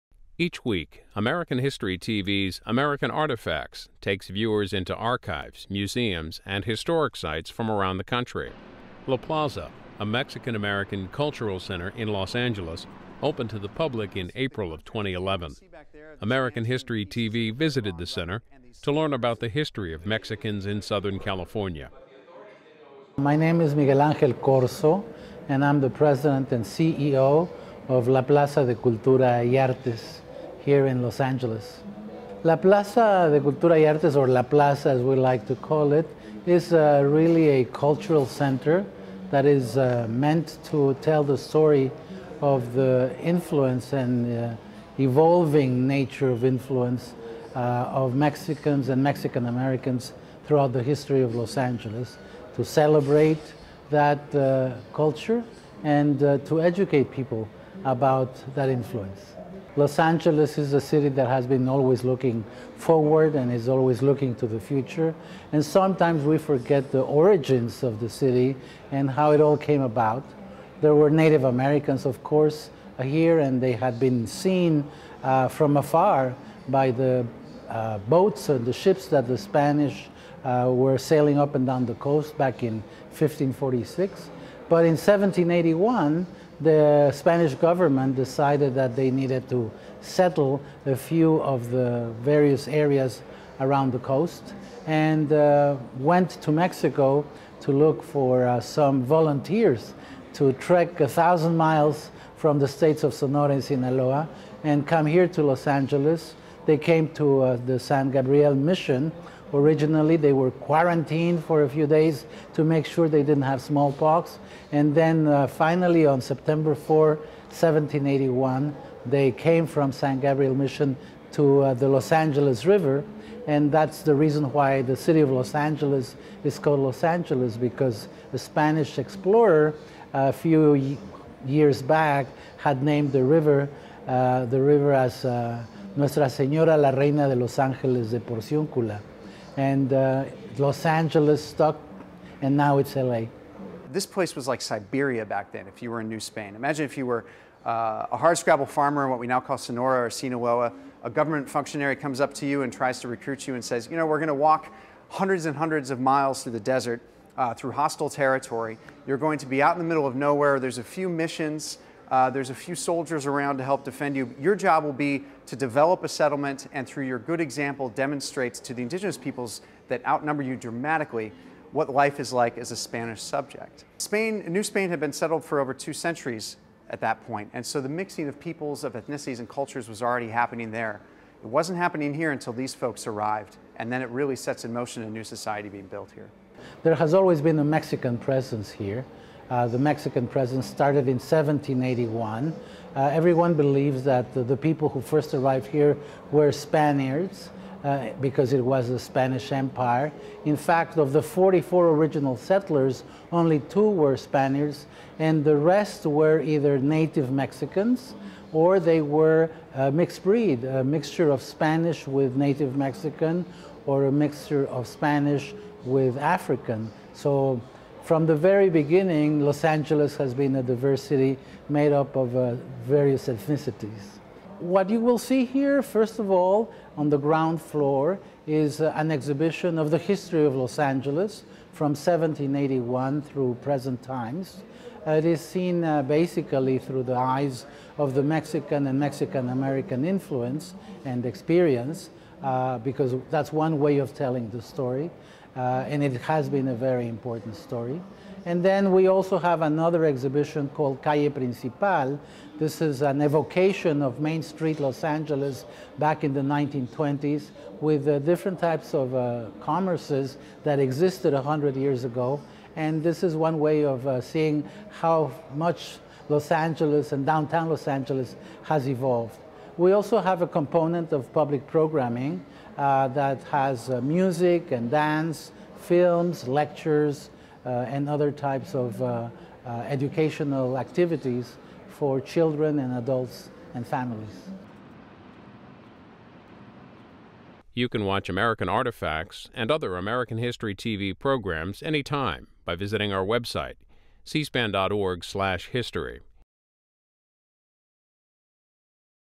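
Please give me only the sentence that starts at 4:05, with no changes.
Uh, and it has been a very important story.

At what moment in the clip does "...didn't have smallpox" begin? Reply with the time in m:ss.
1:53.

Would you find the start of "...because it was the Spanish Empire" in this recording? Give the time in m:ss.
3:18.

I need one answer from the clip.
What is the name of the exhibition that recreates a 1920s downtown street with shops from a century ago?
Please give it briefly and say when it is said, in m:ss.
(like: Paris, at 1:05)
Calle Principal, at 4:11.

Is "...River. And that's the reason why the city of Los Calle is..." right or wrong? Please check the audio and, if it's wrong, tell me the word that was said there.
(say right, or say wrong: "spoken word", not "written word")
wrong: "Angeles", not "Calle".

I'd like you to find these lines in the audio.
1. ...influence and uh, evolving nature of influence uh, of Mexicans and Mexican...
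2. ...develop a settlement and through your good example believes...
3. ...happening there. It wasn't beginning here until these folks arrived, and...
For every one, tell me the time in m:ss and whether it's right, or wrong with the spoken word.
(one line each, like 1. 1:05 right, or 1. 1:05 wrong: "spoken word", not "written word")
1. 0:43 right
2. 2:45 wrong: "demonstrates", not "believes"
3. 3:00 wrong: "happening", not "beginning".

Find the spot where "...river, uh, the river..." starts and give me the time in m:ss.
2:13.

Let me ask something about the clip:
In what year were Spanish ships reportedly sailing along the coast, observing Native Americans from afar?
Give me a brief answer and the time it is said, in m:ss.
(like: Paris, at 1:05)
1546, at 1:23.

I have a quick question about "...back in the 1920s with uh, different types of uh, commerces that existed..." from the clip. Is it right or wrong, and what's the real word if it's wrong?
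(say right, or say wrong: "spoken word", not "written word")
right.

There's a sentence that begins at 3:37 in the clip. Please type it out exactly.
So from the very beginning, Los Angeles has been a diverse city made up of uh, various ethnicities.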